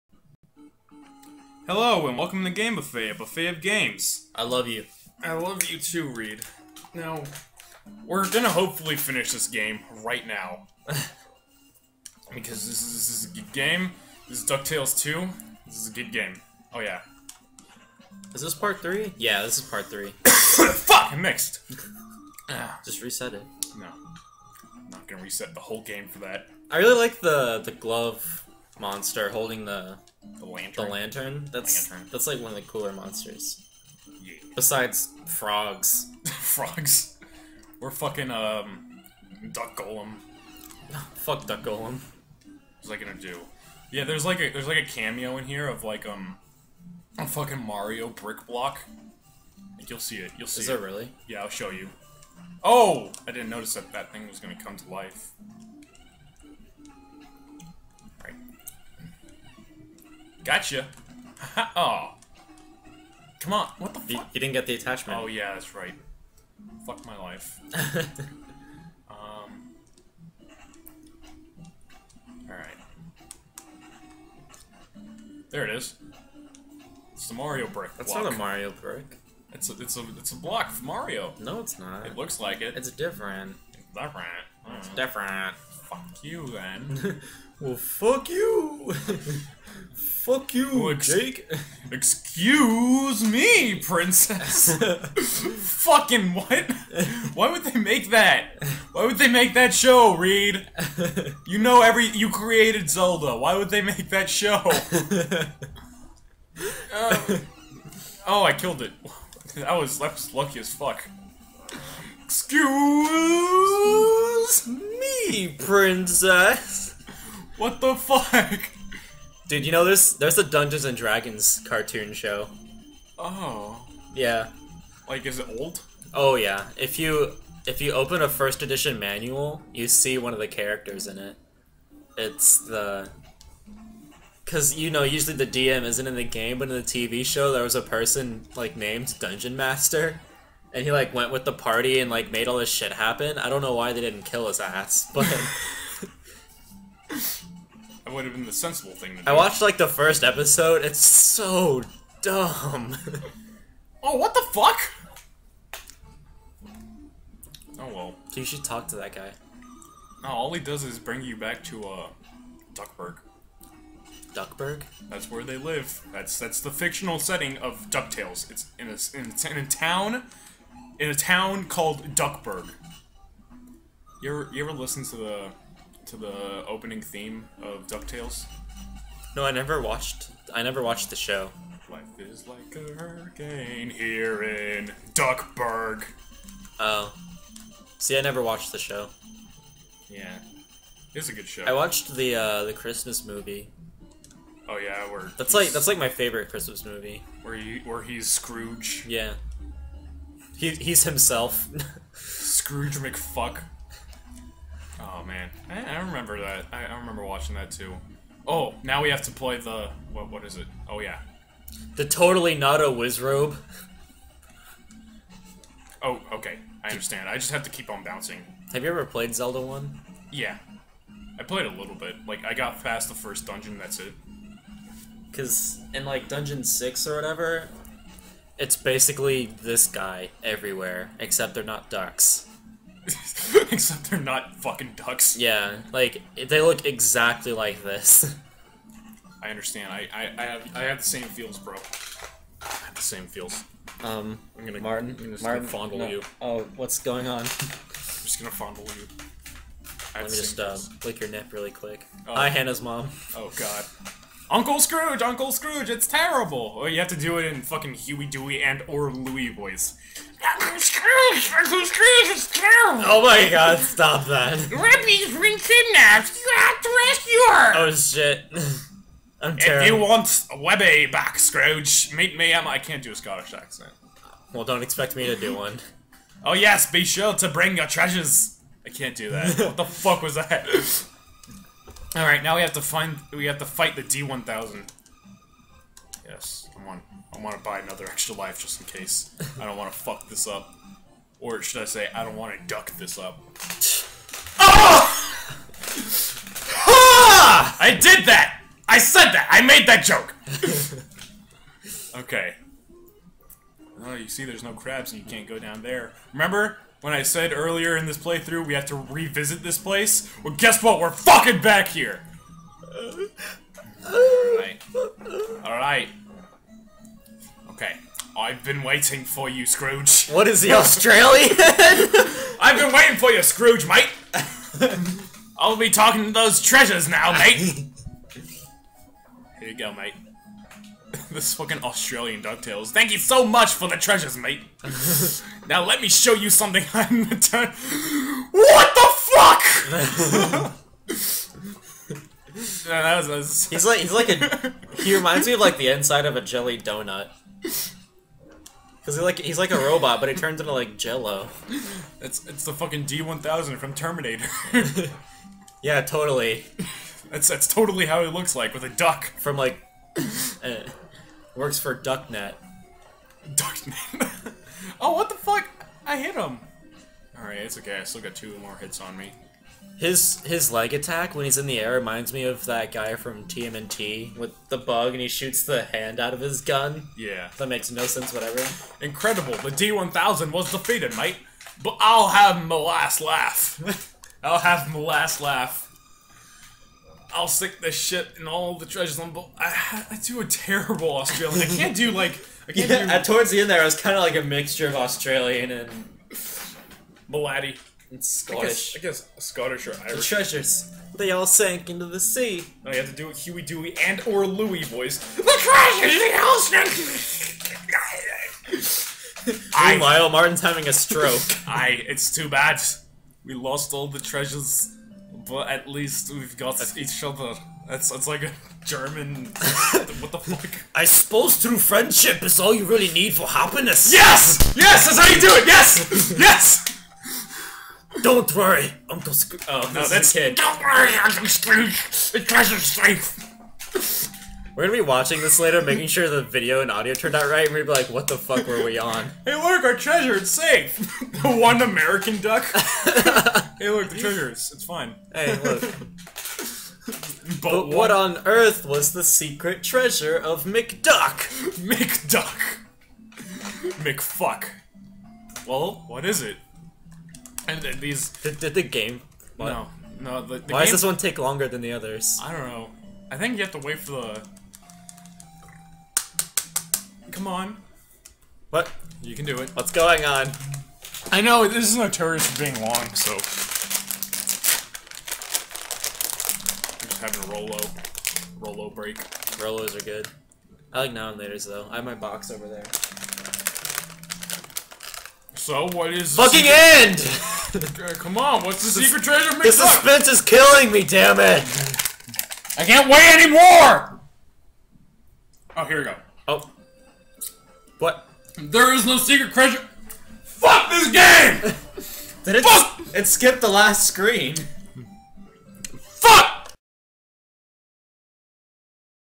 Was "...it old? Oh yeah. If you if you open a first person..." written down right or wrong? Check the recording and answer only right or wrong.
wrong.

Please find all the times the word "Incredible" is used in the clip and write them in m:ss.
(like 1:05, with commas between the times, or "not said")
6:19.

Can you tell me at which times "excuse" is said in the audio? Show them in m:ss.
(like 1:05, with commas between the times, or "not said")
1:31, 1:52.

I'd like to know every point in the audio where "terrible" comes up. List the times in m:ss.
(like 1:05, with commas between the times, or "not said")
4:16, 4:22, 4:29, 6:30.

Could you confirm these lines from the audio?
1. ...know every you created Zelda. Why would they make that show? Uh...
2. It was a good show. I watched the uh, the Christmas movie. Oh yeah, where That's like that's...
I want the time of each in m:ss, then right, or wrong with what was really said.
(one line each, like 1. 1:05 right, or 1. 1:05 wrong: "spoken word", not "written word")
1. 1:41 right
2. 3:11 right.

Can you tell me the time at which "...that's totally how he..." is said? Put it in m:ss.
5:57.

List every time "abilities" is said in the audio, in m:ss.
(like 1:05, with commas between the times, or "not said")
not said.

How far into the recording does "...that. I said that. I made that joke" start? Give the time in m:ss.
4:58.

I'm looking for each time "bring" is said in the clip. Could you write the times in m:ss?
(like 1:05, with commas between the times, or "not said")
2:40, 4:37.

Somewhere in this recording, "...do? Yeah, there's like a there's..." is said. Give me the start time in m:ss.
0:43.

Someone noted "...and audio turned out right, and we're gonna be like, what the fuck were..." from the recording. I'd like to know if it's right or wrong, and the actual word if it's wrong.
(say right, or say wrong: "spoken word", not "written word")
right.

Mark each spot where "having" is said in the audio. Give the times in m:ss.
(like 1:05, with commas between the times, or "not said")
6:50, 7:57.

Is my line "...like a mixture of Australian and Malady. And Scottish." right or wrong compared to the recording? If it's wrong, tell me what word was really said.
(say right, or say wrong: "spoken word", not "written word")
right.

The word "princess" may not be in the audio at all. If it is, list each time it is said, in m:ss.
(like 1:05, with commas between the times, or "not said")
1:33, 1:55.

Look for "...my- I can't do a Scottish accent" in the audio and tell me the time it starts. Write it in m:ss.
4:32.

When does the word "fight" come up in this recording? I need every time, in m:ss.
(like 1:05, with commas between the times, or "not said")
4:43.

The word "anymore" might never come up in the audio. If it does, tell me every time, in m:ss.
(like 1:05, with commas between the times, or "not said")
8:13.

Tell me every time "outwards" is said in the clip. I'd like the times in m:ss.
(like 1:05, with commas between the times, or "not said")
not said.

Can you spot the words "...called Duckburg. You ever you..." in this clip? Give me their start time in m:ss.
2:51.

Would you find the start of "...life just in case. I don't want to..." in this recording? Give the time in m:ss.
4:48.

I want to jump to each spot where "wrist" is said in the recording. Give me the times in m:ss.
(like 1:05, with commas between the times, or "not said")
not said.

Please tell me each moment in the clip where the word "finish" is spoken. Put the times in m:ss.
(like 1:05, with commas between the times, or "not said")
0:08.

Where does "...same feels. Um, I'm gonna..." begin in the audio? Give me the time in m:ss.
4:03.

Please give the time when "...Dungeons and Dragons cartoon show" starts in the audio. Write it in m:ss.
2:00.